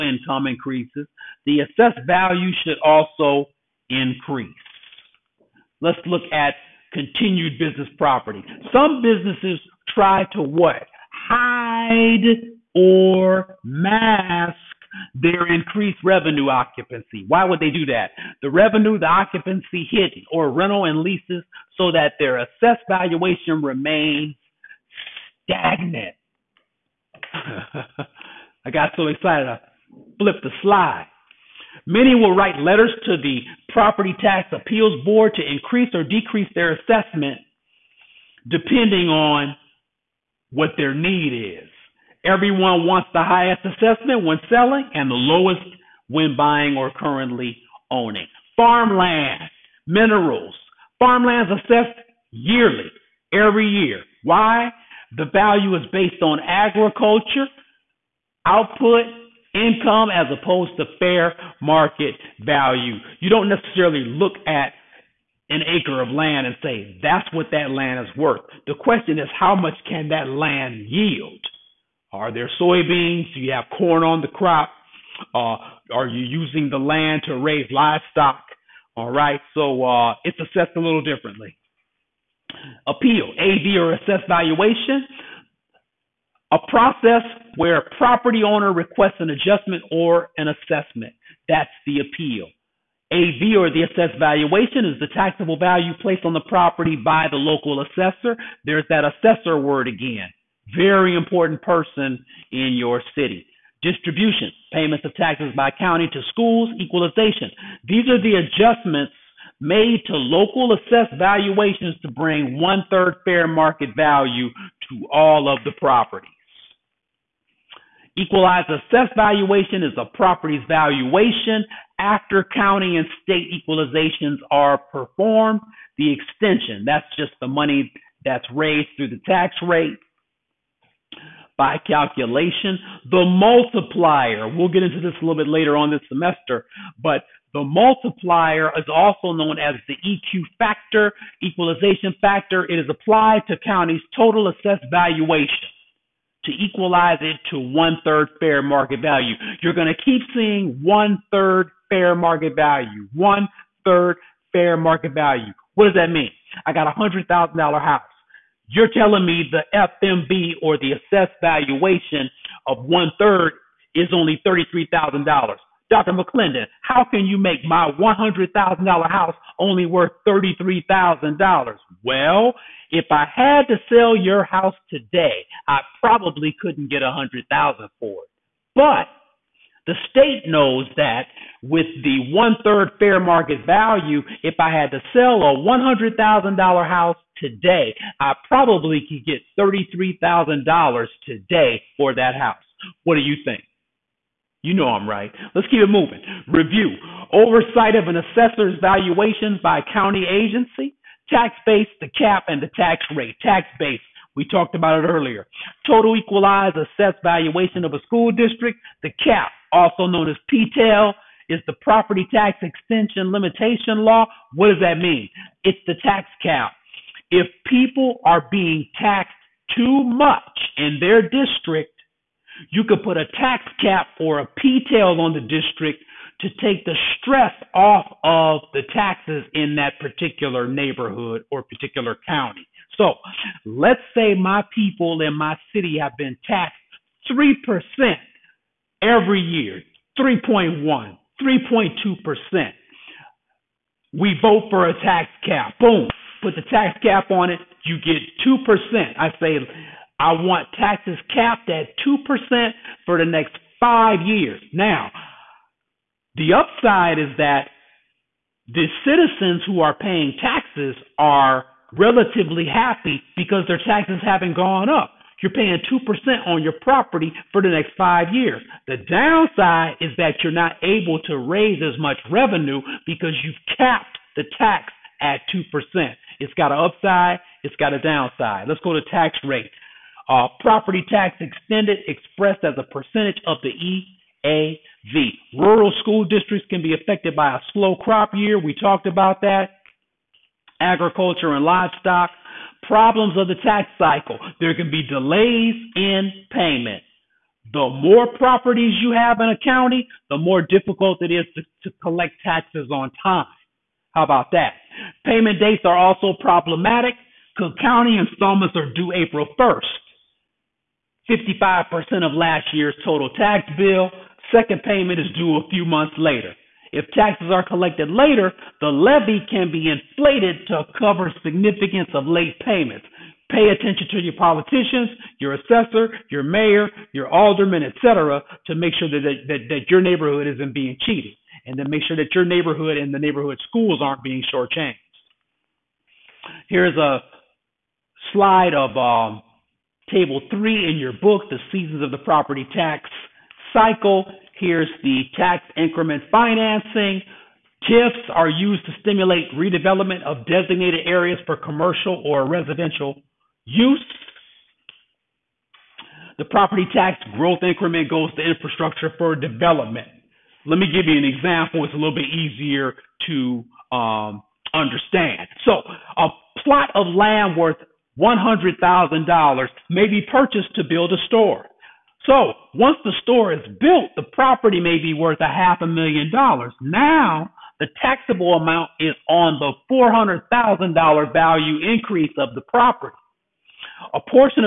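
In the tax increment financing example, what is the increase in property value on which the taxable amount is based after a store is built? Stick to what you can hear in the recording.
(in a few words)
$400,000.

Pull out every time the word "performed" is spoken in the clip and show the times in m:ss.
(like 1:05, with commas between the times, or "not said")
2:04.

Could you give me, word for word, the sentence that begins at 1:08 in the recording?
The question is how much can that land yield?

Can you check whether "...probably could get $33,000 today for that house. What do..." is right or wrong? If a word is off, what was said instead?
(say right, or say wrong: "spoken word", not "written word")
right.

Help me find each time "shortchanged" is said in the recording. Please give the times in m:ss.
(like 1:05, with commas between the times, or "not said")
5:34.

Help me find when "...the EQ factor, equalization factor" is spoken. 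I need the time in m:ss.
2:19.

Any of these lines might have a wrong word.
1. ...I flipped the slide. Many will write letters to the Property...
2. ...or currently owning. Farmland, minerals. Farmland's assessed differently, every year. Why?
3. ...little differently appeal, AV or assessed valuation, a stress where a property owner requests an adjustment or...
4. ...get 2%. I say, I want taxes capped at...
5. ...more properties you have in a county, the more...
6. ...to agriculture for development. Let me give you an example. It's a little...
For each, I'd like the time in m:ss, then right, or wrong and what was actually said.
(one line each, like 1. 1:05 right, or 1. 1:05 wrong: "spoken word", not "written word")
1. 0:29 right
2. 0:46 wrong: "yearly", not "differently"
3. 1:20 wrong: "process", not "stress"
4. 4:07 right
5. 4:57 right
6. 5:58 wrong: "infrastructure", not "agriculture".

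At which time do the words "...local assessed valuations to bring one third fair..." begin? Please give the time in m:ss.
1:50.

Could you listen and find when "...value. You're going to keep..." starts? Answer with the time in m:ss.
2:29.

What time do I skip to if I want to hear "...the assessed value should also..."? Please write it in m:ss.
0:01.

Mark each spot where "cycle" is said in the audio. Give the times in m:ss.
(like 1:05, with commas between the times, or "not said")
4:53, 5:43.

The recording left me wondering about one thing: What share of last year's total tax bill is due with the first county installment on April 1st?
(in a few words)
55%.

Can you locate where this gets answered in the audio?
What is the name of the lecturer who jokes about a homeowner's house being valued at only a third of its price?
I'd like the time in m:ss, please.
2:45.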